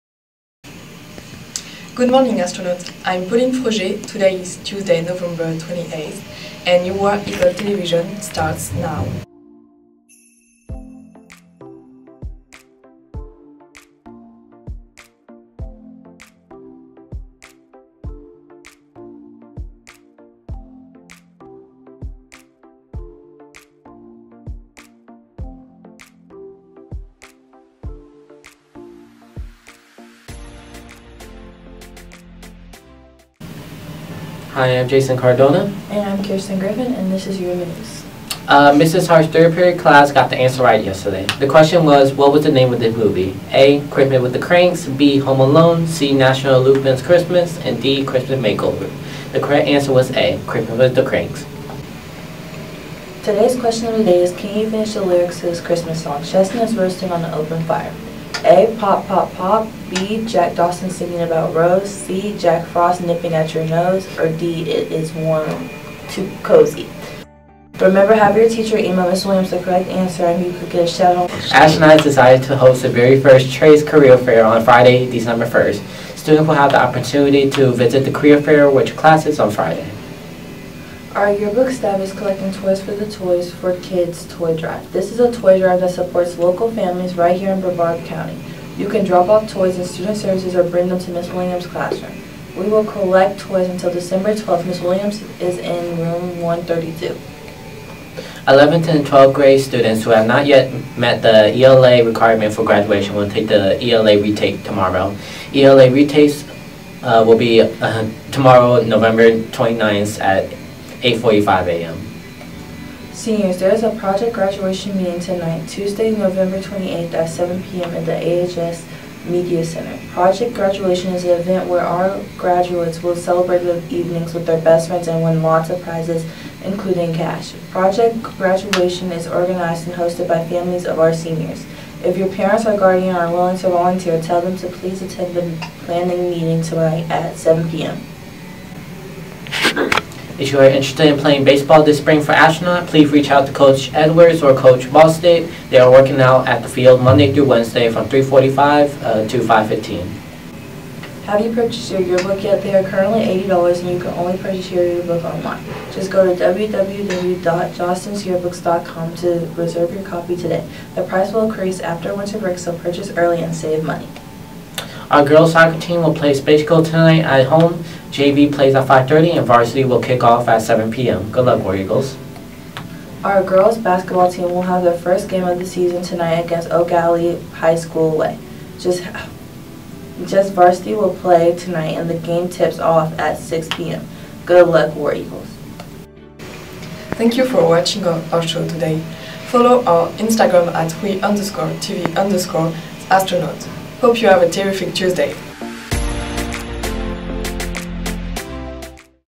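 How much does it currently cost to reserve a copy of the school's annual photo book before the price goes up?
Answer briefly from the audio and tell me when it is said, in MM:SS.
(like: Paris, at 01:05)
$80, at 02:33.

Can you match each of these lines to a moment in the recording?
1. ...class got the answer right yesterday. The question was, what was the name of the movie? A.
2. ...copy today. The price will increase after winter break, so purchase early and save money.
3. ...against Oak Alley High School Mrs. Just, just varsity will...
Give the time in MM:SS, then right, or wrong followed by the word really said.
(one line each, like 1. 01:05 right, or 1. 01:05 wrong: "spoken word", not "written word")
1. 00:39 right
2. 02:40 right
3. 02:56 wrong: "Way", not "Mrs".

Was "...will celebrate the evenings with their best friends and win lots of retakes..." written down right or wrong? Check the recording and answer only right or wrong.
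wrong.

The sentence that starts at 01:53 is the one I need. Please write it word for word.
Seniors, there is a project graduation meeting tonight, Tuesday, November 28th at 7 p.m.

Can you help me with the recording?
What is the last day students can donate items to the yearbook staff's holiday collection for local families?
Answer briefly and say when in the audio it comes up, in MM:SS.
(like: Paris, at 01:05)
December 12th, at 01:33.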